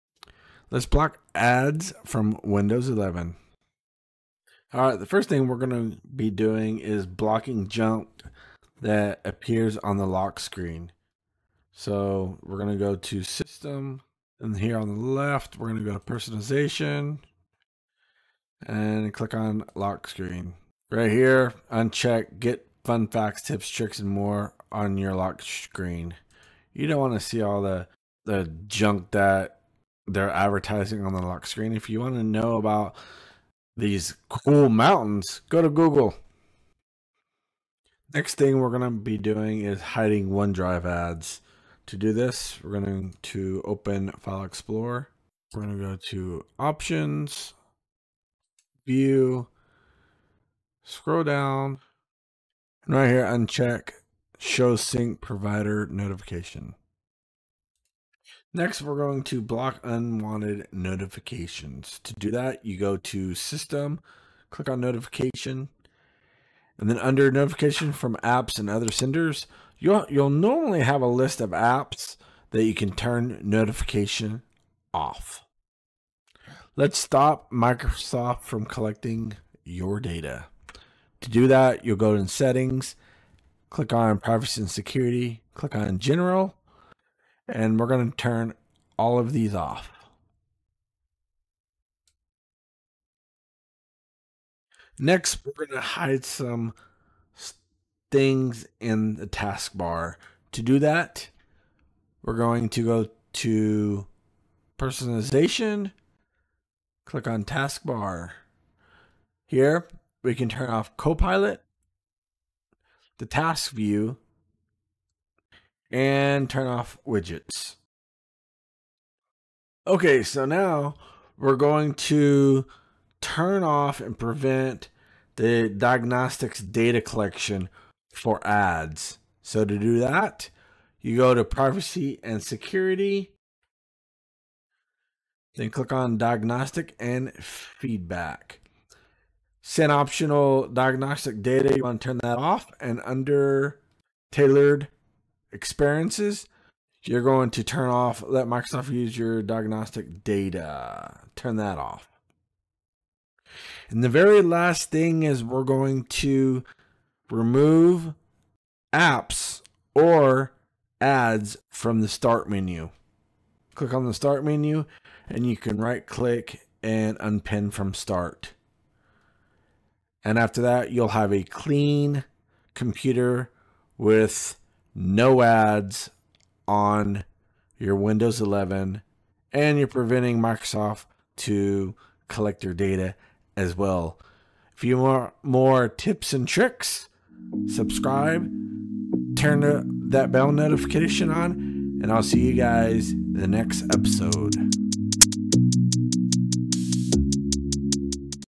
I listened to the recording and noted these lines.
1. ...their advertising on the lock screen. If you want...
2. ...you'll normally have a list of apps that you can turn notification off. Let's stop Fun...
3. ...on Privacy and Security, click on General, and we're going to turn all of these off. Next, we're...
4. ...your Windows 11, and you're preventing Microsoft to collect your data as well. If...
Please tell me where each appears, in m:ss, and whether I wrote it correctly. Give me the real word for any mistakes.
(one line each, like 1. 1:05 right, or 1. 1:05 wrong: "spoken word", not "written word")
1. 0:30 right
2. 1:10 wrong: "Microsoft", not "Fun"
3. 1:23 right
4. 2:57 right.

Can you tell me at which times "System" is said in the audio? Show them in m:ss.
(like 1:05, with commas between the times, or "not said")
0:13, 1:03.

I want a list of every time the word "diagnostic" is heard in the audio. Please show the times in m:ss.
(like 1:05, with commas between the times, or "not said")
2:05, 2:16, 2:20, 2:29.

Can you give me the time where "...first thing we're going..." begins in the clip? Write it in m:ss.
0:05.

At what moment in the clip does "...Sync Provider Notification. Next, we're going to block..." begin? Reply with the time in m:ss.
0:54.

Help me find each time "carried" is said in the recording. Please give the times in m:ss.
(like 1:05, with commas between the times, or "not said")
not said.